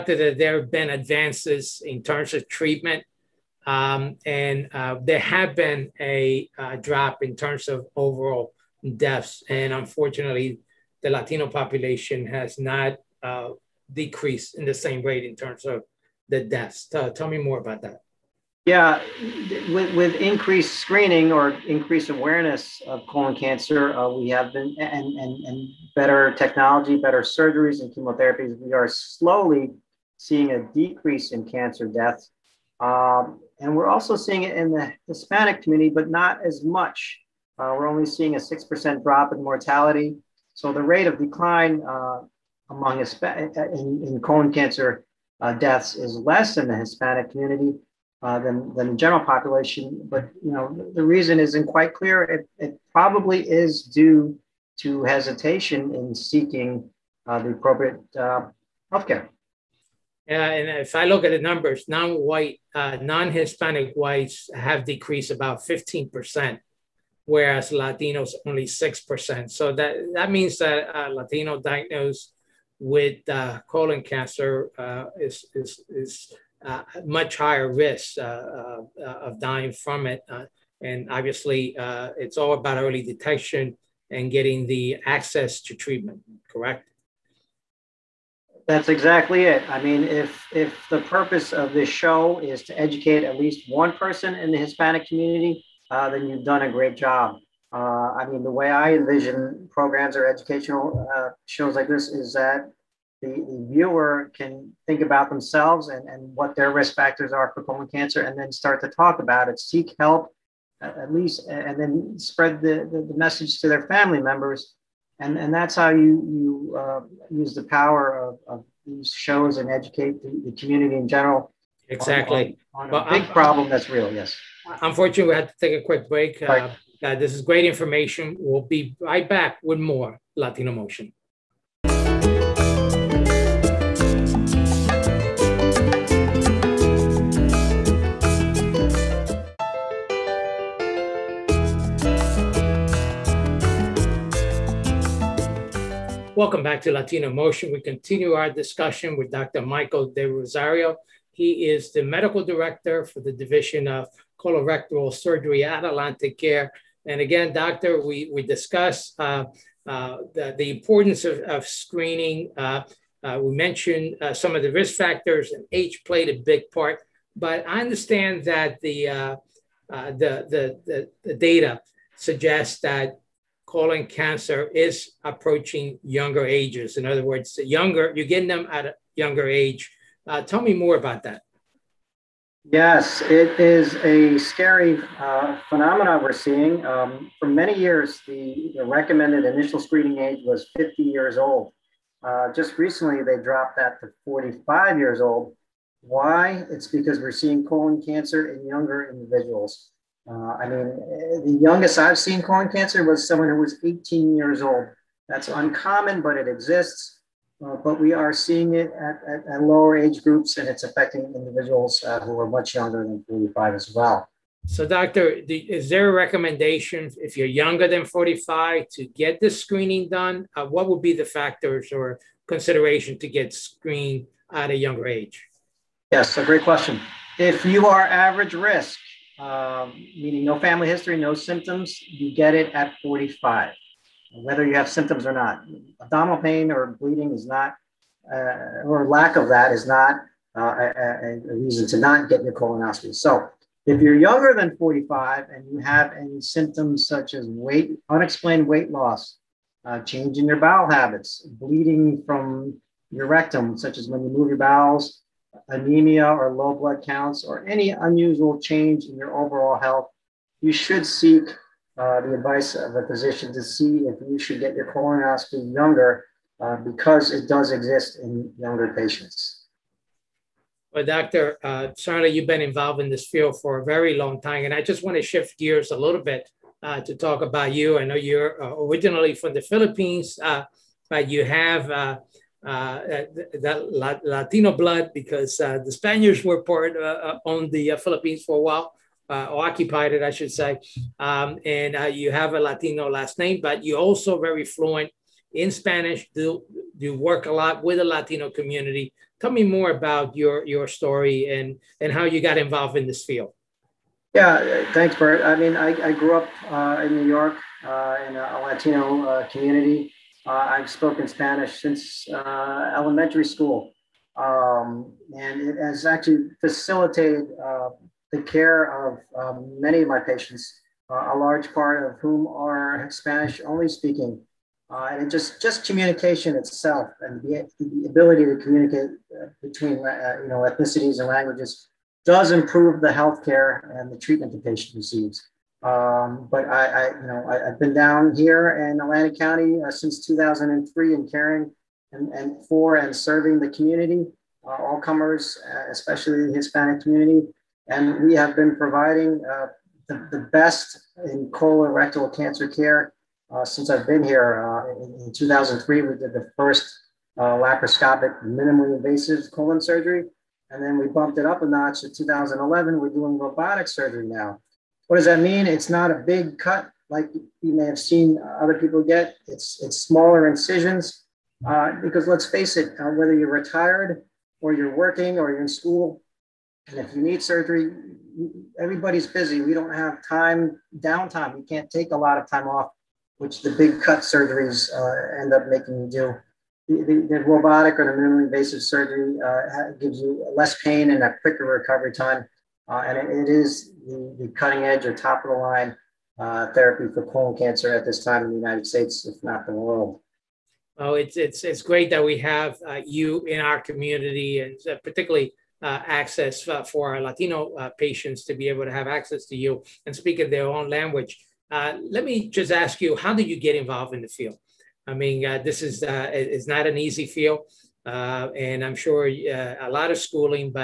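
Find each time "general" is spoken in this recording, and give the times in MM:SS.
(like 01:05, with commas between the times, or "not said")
00:48, 02:01.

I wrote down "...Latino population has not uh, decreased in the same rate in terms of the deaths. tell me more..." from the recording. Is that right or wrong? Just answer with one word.
right.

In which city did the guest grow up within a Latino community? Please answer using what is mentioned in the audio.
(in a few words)
New York.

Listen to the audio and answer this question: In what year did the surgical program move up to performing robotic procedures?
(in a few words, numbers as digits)
2011.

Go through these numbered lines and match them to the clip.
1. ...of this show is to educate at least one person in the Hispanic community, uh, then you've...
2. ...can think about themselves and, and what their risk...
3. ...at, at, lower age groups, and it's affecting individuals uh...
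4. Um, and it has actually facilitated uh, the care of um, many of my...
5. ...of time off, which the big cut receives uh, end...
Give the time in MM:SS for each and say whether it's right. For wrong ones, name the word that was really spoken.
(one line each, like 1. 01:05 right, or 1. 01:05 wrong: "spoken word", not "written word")
1. 01:31 right
2. 01:44 right
3. 03:29 right
4. 05:14 right
5. 06:22 wrong: "surgeries", not "receives".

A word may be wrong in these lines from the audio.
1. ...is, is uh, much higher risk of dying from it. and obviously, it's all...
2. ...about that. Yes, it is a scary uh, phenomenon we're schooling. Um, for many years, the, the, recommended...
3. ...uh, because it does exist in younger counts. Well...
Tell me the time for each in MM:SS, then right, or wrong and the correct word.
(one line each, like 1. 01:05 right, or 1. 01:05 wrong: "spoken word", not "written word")
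1. 01:15 right
2. 03:00 wrong: "seeing", not "schooling"
3. 04:26 wrong: "patients", not "counts".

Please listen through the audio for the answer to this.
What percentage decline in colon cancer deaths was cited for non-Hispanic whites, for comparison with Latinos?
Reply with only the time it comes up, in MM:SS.
01:05.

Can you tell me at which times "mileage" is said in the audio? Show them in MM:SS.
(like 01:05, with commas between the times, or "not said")
not said.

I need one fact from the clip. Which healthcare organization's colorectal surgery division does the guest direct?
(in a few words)
AtlantiCare.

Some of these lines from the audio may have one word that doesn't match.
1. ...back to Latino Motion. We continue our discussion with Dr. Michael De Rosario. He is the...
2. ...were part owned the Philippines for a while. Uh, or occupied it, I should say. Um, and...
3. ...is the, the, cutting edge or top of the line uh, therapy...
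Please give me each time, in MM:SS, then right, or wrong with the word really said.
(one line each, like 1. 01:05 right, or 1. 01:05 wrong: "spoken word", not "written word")
1. 02:26 right
2. 04:46 right
3. 06:33 right.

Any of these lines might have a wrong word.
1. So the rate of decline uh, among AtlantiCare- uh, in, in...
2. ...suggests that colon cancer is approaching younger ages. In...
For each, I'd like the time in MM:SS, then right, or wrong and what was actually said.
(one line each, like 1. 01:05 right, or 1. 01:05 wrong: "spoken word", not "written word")
1. 00:40 wrong: "Hisp", not "AtlantiCare"
2. 02:52 right.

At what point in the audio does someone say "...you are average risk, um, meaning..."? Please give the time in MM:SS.
03:47.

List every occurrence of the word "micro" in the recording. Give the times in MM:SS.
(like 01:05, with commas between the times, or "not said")
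not said.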